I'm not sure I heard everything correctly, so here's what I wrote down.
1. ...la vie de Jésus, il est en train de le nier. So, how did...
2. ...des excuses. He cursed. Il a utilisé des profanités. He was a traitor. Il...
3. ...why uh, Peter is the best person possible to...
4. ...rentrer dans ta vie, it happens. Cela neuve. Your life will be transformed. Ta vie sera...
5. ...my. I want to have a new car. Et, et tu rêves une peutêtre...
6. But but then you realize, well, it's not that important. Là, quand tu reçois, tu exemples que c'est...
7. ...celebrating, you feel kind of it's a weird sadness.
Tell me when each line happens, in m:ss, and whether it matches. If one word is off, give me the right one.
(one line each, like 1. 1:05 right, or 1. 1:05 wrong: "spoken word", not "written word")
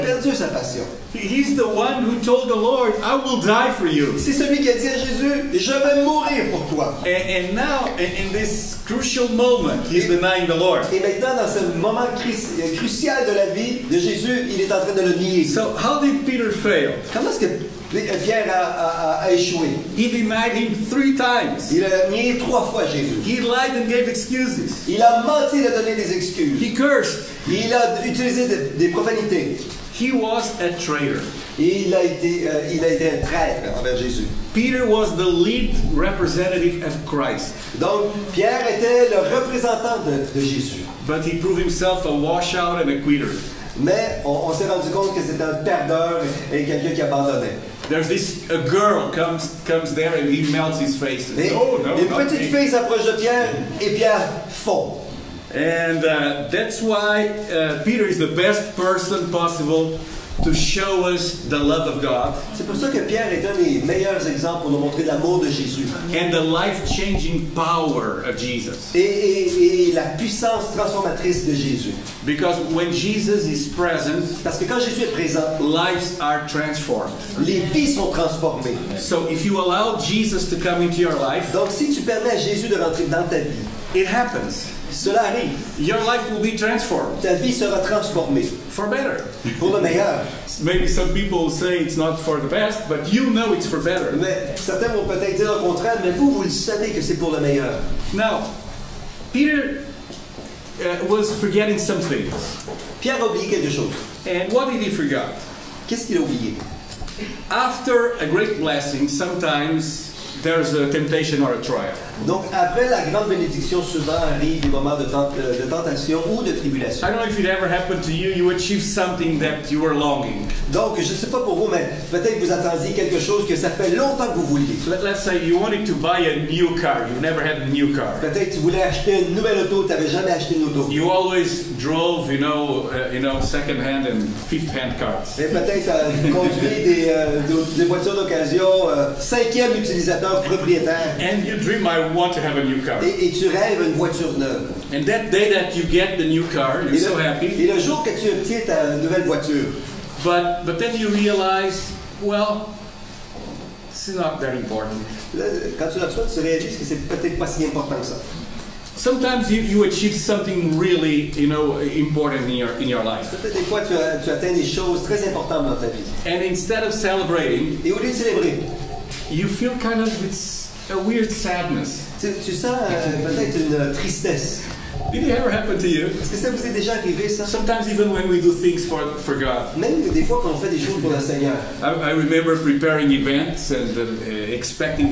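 1. 0:13 right
2. 0:25 right
3. 0:56 right
4. 1:22 wrong: "arrive", not "neuve"
5. 2:21 wrong: "voiture", not "peutêtre"
6. 2:30 wrong: "réalises", not "exemples"
7. 2:46 right.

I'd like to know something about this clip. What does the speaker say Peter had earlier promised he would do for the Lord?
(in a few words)
Die for you.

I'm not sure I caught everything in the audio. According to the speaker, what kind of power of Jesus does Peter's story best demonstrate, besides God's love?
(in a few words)
Life-changing power.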